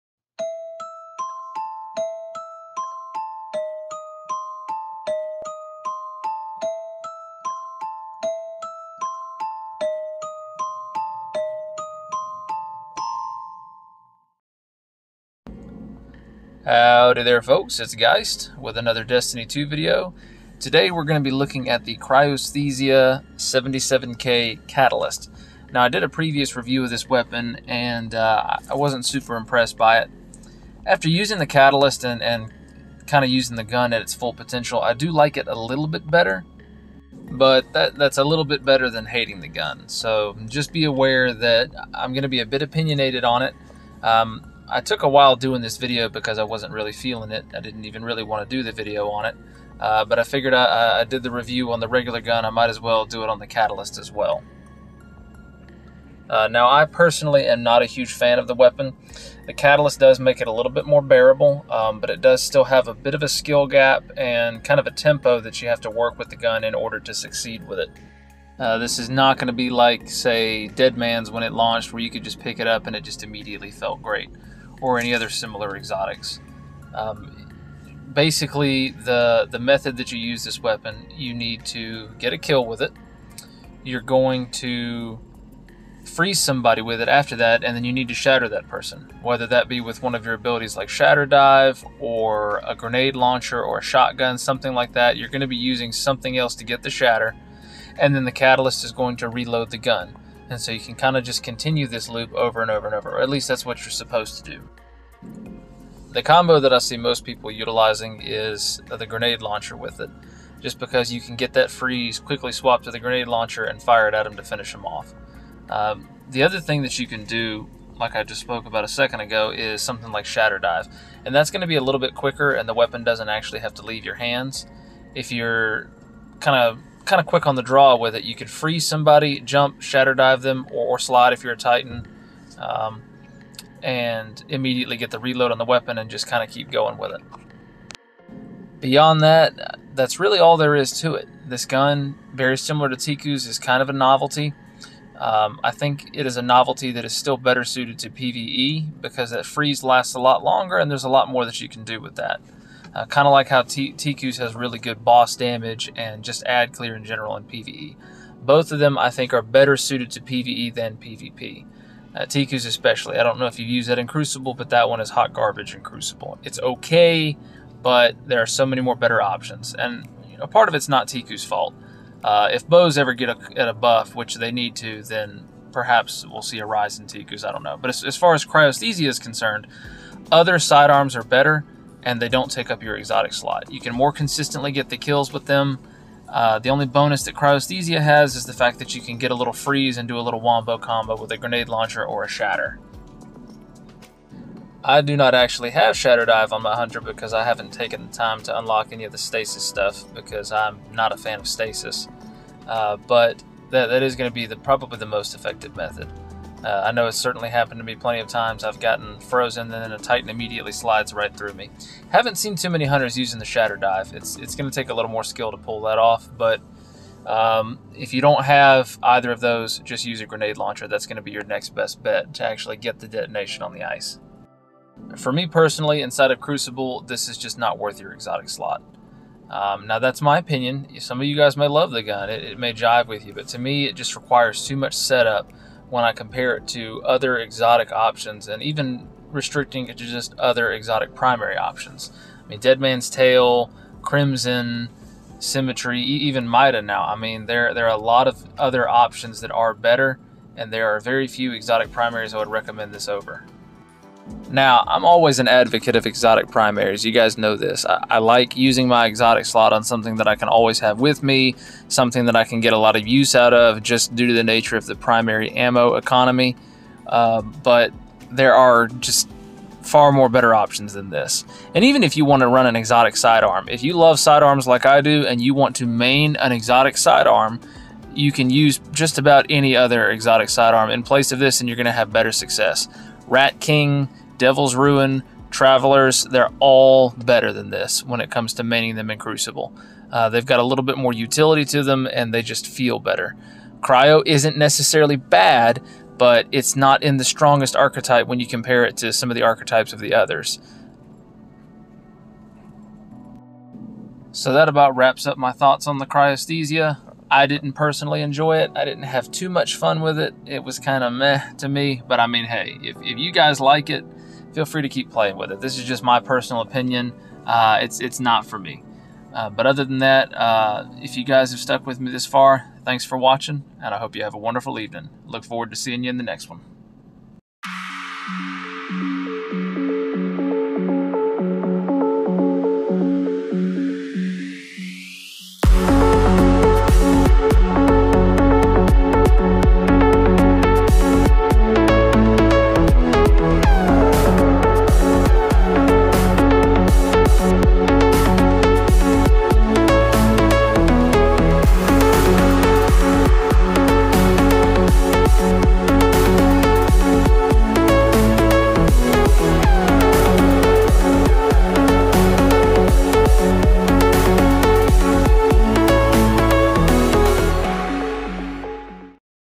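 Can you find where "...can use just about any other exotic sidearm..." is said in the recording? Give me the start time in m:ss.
4:38.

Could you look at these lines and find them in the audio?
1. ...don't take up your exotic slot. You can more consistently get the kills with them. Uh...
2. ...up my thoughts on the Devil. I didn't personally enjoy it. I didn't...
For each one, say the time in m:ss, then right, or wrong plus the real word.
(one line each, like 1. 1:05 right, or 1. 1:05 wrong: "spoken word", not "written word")
1. 3:02 right
2. 5:05 wrong: "Cryosthesia", not "Devil".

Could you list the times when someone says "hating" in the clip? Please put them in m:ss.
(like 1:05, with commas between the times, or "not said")
0:39.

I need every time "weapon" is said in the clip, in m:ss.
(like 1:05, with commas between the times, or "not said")
0:27, 0:58, 1:20, 2:02, 2:15.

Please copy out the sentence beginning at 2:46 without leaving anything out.
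It's okay, but there are so many more better options.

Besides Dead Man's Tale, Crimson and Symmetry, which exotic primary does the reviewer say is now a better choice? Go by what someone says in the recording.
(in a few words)
Mida.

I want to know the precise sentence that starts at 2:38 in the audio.
Both of them, I think, are better suited to PvE than PvP.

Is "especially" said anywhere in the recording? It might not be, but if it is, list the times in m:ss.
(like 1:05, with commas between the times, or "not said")
2:42.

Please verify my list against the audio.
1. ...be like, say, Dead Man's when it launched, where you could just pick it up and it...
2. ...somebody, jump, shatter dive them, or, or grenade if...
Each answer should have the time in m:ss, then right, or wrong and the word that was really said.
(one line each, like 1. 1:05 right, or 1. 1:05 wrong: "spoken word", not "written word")
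1. 1:09 right
2. 2:08 wrong: "slide", not "grenade".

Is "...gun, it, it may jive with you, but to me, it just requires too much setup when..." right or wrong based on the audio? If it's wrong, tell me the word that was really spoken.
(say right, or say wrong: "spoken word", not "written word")
right.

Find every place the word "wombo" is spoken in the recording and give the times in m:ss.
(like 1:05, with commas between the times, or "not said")
3:10.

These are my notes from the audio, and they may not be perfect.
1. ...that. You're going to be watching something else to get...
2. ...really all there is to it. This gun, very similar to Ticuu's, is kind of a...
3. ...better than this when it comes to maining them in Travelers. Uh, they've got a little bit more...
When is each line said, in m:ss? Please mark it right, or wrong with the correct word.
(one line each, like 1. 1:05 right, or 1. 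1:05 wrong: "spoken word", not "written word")
1. 1:34 wrong: "using", not "watching"
2. 2:20 right
3. 4:47 wrong: "Crucible", not "Travelers".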